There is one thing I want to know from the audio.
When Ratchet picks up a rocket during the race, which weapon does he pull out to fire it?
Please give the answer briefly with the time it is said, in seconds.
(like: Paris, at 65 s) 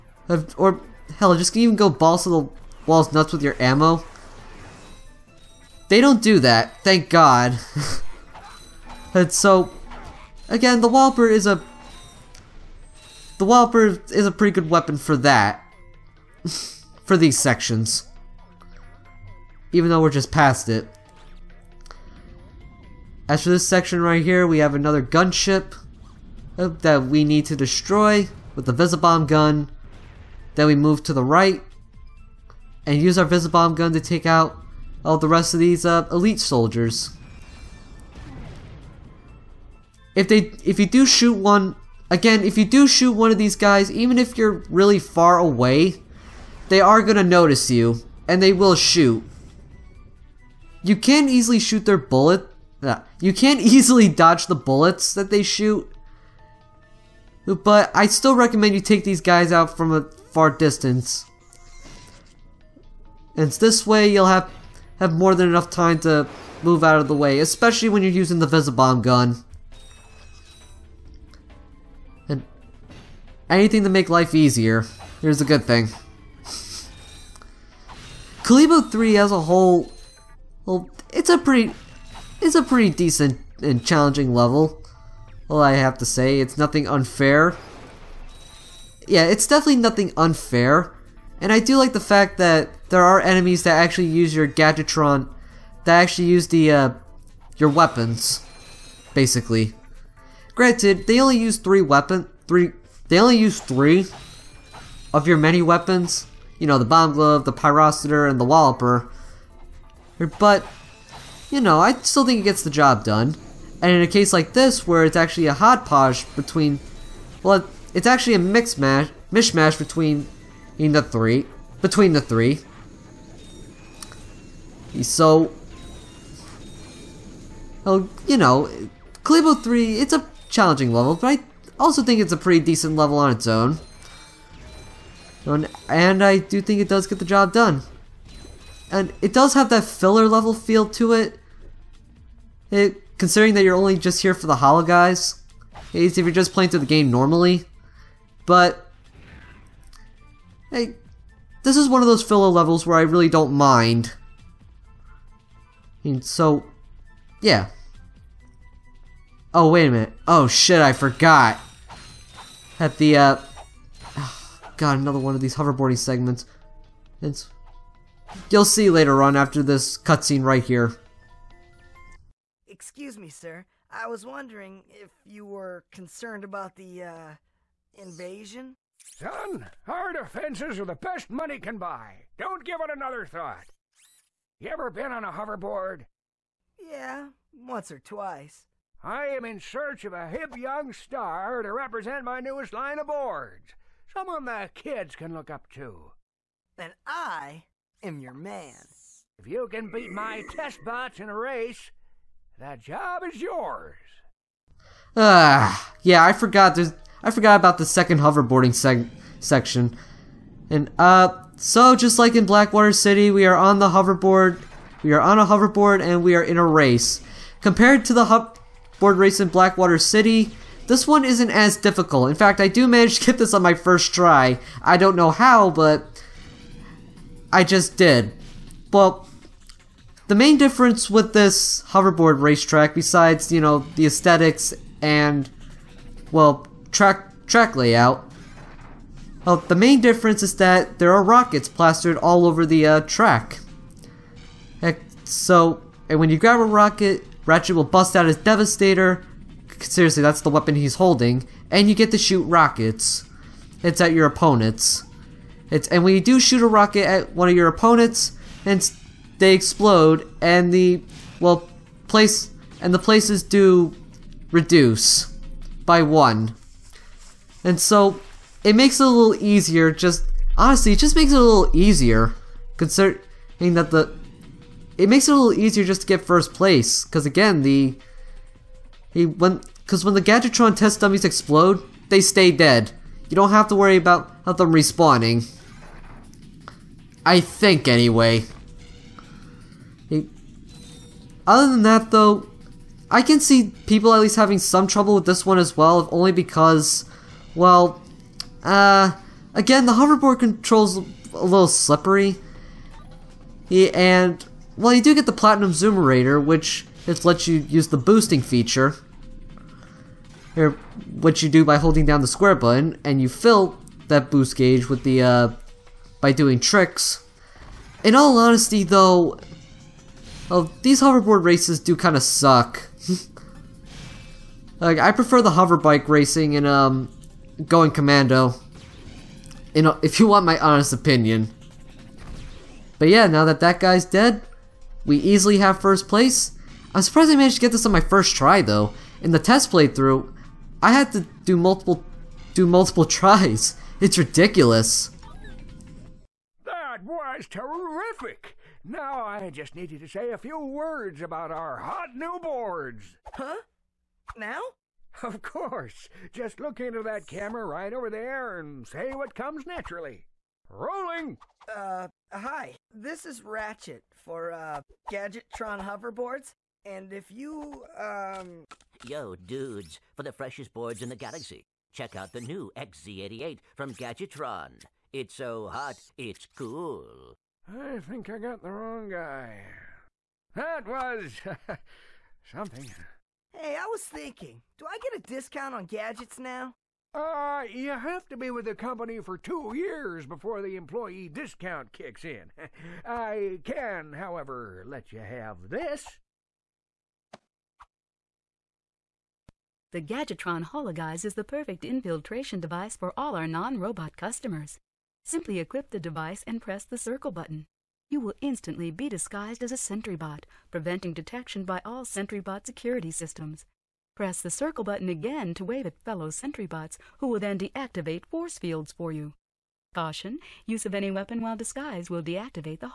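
Devastator, at 248 s.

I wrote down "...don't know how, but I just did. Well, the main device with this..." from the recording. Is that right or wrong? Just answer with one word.
wrong.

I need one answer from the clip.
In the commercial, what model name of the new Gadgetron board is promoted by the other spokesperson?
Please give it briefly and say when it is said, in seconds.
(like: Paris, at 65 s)
XZ88, at 372 s.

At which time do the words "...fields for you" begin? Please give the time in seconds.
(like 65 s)
418 s.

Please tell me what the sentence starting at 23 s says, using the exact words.
As for this section right here, we have another gunship uh, that we need to destroy with the Visibomb gun.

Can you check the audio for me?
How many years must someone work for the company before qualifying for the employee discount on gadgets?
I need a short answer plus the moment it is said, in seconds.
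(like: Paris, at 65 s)
2, at 389 s.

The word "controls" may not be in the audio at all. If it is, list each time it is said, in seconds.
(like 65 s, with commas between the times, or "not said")
300 s.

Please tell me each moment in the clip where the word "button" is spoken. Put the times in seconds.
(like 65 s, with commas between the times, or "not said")
312 s, 407 s, 414 s.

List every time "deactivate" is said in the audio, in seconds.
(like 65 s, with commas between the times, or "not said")
417 s, 422 s.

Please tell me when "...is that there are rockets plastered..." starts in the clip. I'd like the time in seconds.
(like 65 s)
240 s.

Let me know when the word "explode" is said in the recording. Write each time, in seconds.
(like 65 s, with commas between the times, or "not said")
259 s, 281 s.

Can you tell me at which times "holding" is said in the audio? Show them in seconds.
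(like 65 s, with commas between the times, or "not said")
250 s, 311 s.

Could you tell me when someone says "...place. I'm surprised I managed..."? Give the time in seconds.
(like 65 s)
336 s.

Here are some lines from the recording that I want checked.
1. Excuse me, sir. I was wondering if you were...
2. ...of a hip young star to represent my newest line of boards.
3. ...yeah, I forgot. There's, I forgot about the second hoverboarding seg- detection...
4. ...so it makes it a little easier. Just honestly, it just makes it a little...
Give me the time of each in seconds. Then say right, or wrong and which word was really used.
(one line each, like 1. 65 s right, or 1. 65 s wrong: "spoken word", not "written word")
1. 172 s right
2. 190 s right
3. 206 s wrong: "section", not "detection"
4. 267 s right.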